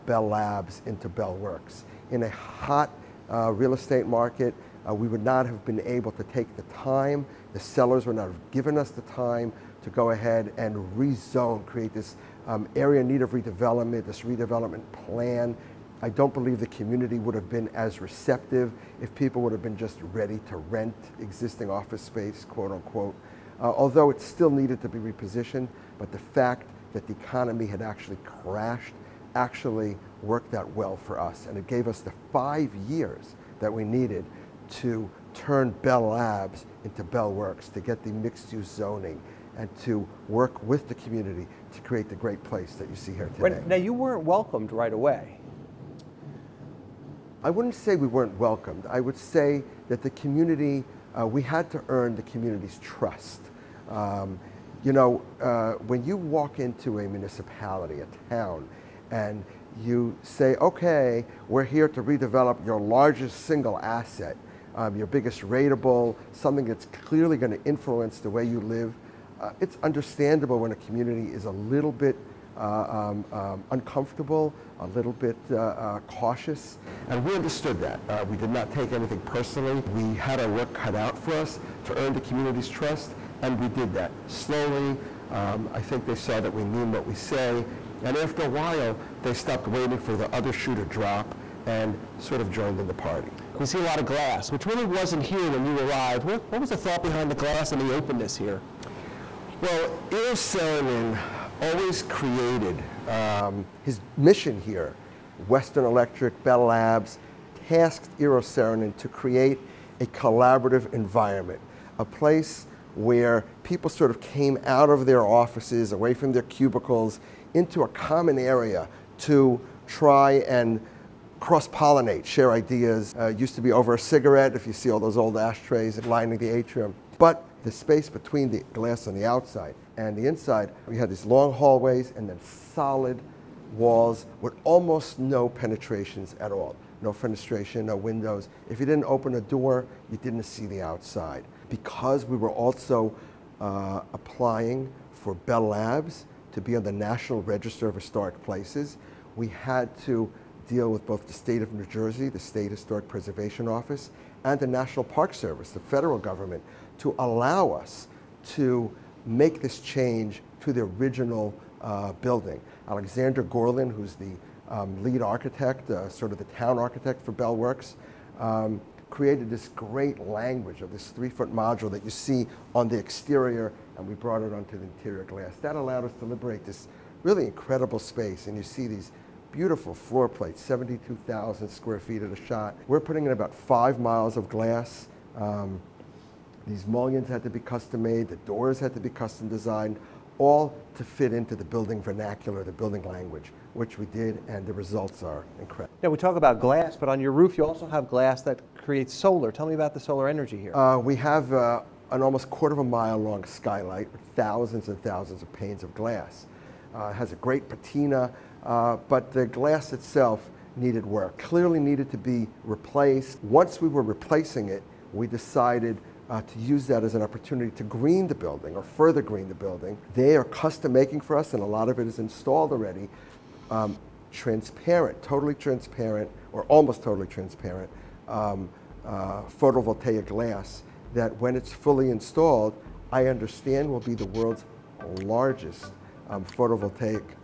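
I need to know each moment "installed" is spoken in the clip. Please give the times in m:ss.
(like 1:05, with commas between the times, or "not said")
3:42, 3:52.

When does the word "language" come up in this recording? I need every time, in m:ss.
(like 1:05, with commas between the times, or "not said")
2:50, 3:13.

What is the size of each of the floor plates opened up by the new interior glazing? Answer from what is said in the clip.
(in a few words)
72,000 square feet.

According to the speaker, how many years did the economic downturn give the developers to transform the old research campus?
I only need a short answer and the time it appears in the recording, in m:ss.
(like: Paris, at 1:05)
5, at 0:32.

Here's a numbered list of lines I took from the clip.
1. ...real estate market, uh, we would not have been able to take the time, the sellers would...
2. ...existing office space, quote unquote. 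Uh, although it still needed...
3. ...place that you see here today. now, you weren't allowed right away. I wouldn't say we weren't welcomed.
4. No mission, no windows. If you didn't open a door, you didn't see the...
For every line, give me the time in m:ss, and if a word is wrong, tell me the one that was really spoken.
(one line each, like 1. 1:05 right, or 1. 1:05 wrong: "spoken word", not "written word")
1. 0:03 right
2. 0:21 right
3. 0:42 wrong: "welcomed", not "allowed"
4. 2:17 wrong: "fenestration", not "mission".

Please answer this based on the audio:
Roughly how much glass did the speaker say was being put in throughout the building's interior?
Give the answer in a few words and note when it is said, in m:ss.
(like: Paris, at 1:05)
5 miles, at 3:03.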